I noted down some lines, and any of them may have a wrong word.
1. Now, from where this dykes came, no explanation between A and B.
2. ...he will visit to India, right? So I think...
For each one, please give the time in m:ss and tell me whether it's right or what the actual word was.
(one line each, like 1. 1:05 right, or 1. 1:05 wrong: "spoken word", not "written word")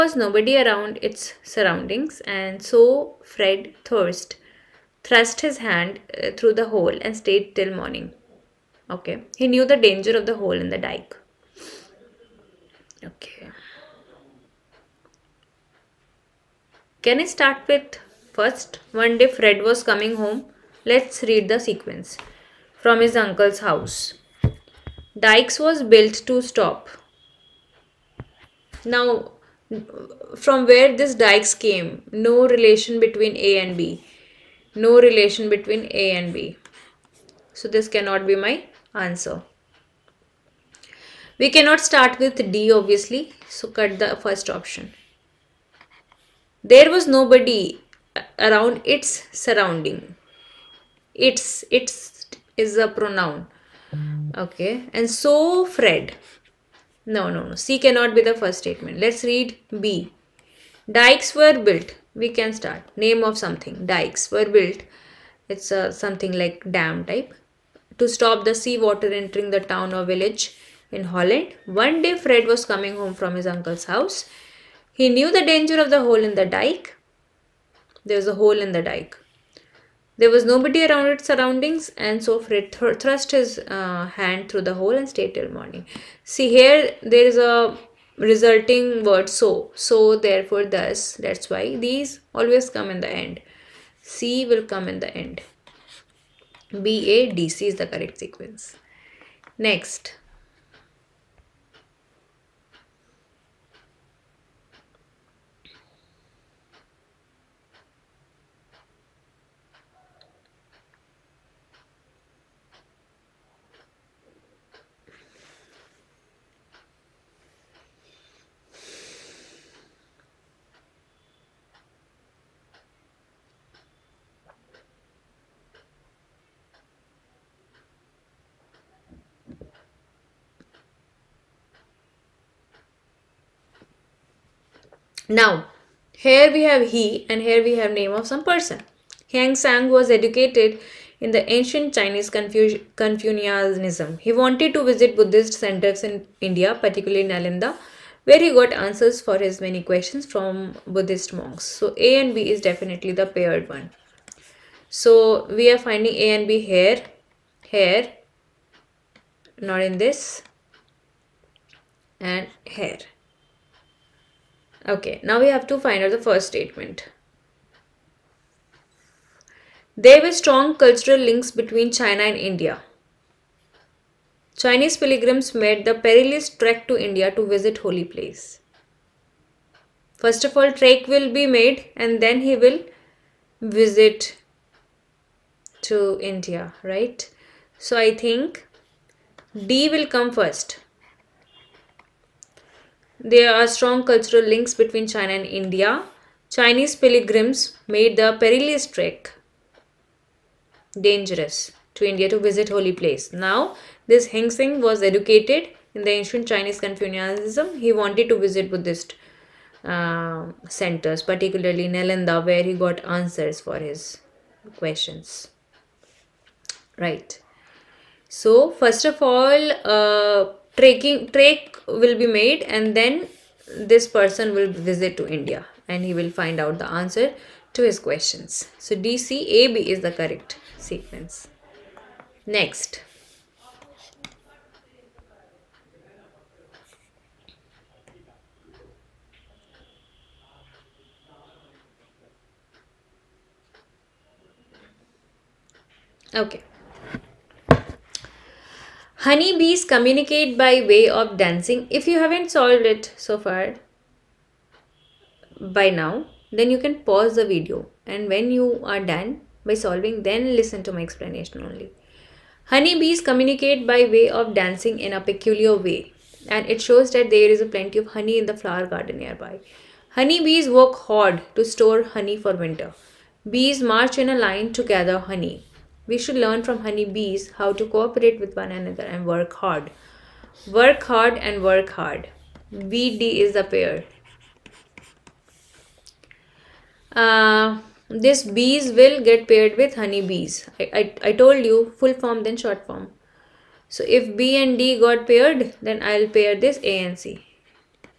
1. 0:28 wrong: "relation", not "explanation"
2. 3:02 right.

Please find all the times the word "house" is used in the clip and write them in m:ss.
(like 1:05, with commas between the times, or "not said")
0:23, 1:13.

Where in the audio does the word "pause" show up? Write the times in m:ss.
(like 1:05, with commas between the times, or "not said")
4:17.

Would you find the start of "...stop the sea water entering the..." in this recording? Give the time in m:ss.
1:08.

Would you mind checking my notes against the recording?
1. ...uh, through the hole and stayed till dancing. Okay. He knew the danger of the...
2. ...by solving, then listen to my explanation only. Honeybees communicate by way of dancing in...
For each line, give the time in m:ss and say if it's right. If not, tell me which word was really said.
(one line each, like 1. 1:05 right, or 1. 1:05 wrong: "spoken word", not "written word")
1. 0:06 wrong: "morning", not "dancing"
2. 4:19 right.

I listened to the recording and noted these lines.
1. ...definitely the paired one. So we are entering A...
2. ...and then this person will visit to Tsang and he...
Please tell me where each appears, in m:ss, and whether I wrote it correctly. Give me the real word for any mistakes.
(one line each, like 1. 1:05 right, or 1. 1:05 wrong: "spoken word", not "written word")
1. 2:32 wrong: "finding", not "entering"
2. 3:42 wrong: "India", not "Tsang".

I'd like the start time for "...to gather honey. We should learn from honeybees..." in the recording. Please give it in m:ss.
4:34.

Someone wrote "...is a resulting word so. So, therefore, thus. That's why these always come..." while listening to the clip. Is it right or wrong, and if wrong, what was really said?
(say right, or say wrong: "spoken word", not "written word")
right.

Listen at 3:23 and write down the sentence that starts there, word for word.
Now, this Heng was educated in the ancient Chinese Confucianism.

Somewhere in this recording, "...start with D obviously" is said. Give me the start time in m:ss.
0:41.